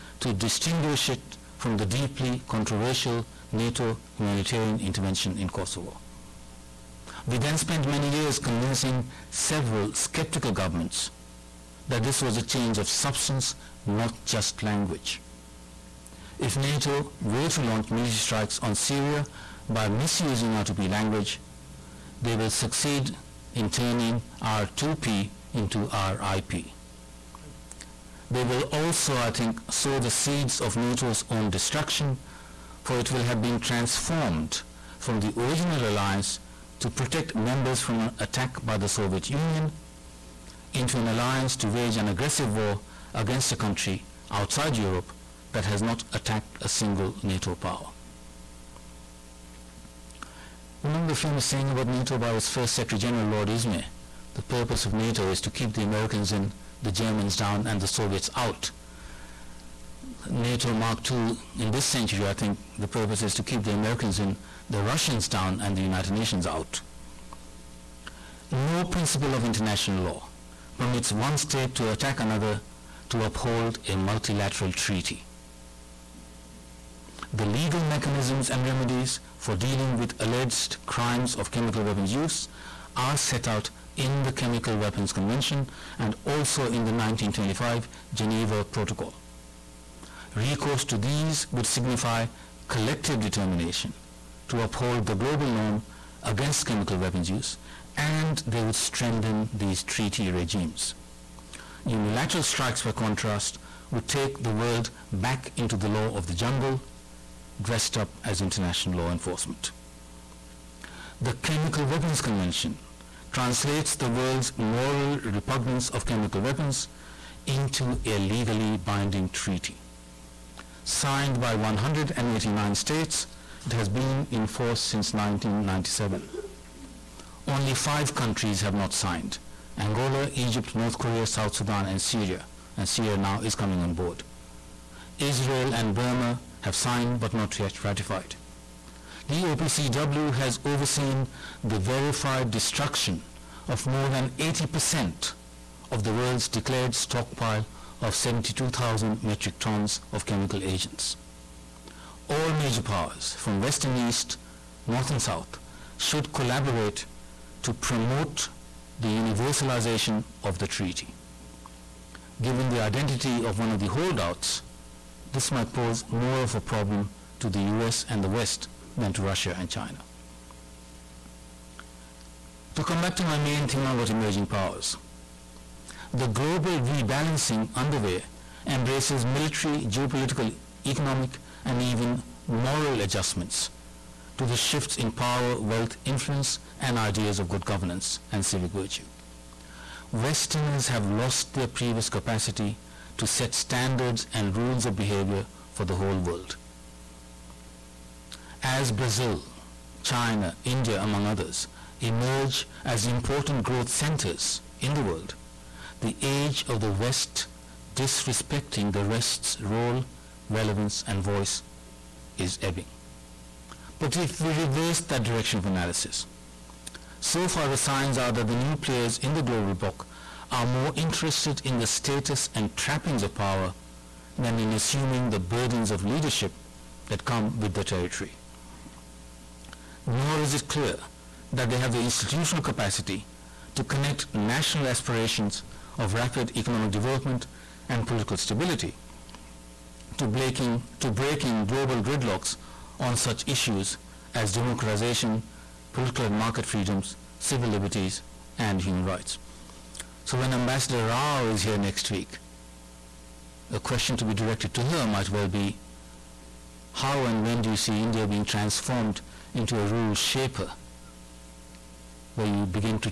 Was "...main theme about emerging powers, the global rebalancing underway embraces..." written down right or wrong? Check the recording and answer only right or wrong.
right.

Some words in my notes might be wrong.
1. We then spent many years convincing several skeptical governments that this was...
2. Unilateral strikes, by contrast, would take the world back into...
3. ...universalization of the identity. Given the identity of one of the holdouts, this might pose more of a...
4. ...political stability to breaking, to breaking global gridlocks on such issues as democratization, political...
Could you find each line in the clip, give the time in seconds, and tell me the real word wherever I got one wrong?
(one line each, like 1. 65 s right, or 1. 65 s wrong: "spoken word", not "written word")
1. 7 s right
2. 101 s right
3. 159 s wrong: "treaty", not "identity"
4. 238 s right.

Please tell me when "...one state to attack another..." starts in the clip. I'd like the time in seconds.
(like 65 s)
71 s.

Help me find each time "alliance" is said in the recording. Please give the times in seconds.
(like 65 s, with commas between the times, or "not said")
35 s, 41 s.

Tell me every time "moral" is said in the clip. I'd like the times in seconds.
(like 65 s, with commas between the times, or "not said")
114 s, 182 s.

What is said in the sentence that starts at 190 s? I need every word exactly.
Westerners have lost their previous capacity to set standards and rules of behavior for the whole world.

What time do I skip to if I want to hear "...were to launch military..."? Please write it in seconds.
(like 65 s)
17 s.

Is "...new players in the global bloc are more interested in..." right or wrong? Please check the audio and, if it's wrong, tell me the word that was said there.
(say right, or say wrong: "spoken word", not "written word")
right.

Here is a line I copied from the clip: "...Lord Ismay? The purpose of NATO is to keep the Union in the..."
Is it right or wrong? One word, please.
wrong.